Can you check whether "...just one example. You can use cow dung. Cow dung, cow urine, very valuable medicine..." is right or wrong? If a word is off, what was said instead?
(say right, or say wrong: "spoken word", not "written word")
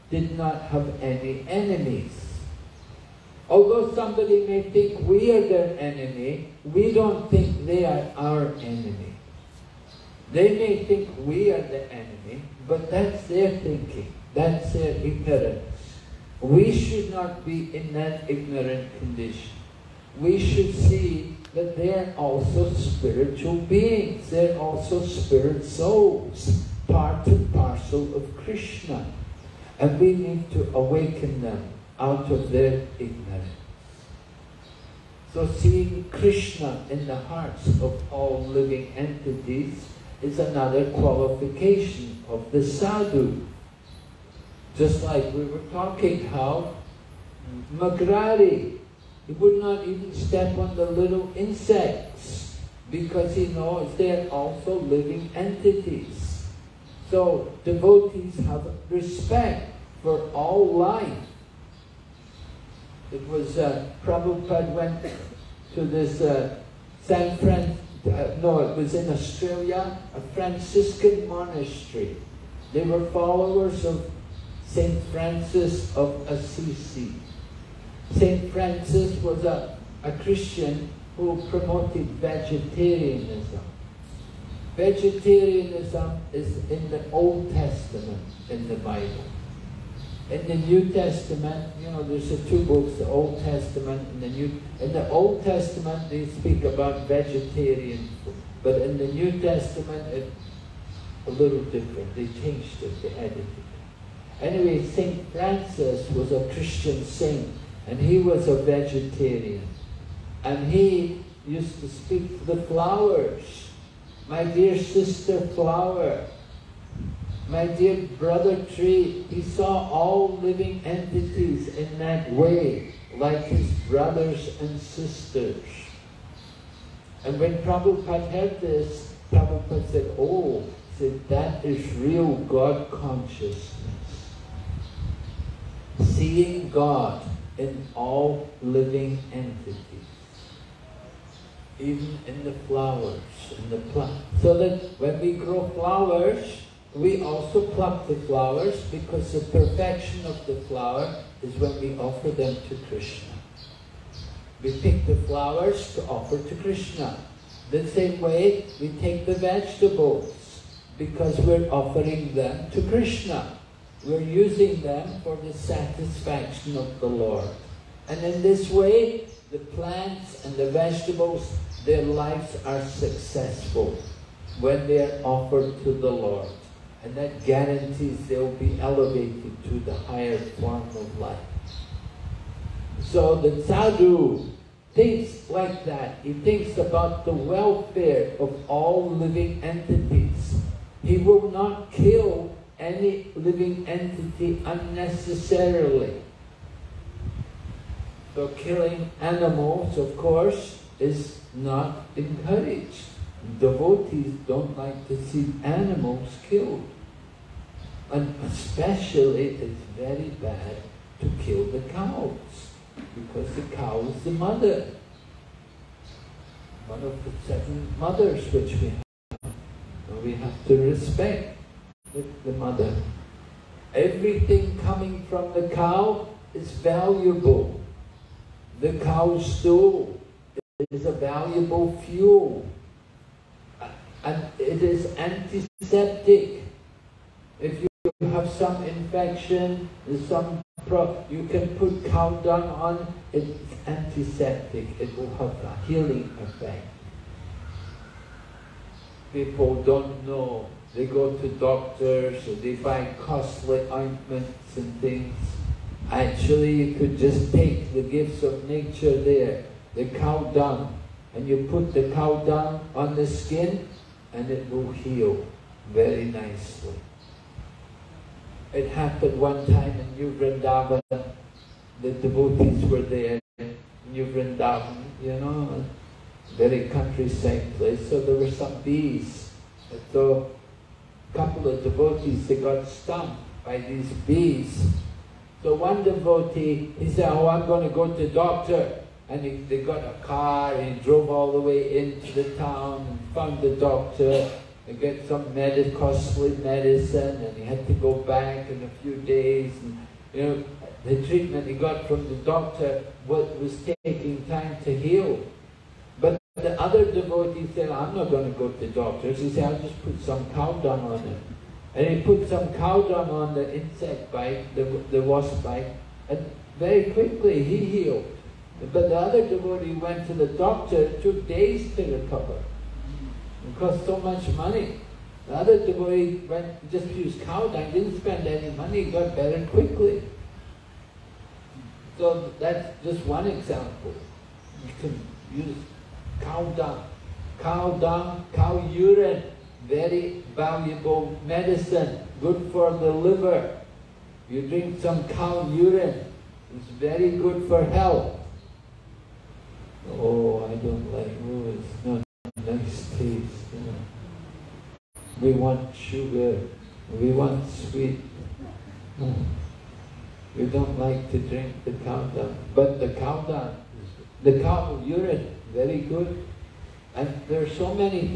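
right.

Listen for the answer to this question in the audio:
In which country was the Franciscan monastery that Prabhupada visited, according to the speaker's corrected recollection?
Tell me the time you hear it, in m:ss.
1:09.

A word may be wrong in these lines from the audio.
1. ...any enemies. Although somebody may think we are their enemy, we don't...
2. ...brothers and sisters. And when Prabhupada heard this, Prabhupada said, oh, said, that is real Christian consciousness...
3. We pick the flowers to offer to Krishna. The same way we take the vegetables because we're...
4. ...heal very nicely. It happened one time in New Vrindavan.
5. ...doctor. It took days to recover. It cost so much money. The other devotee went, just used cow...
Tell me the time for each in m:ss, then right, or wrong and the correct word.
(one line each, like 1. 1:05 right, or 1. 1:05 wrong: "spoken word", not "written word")
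1. 0:01 right
2. 2:03 wrong: "God", not "Christian"
3. 2:34 right
4. 4:24 right
5. 5:20 right.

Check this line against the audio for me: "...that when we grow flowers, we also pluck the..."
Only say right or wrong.
right.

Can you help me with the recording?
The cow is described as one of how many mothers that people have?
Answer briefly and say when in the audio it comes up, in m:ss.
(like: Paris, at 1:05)
7, at 3:37.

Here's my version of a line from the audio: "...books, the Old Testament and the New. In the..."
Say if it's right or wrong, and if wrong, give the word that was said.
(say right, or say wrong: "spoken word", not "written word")
right.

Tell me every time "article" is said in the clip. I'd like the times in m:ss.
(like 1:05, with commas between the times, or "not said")
not said.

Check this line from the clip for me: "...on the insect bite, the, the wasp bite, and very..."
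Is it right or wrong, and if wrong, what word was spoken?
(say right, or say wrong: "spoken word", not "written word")
right.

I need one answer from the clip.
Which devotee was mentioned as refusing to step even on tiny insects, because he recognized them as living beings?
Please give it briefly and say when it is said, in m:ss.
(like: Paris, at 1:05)
Mrigari, at 0:47.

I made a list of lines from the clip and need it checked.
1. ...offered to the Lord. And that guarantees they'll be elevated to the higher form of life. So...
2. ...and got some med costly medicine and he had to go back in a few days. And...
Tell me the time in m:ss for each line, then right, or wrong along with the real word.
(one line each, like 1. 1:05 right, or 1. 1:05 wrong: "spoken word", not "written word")
1. 2:55 right
2. 4:54 right.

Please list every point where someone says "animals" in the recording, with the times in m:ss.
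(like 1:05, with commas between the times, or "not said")
3:19, 3:25.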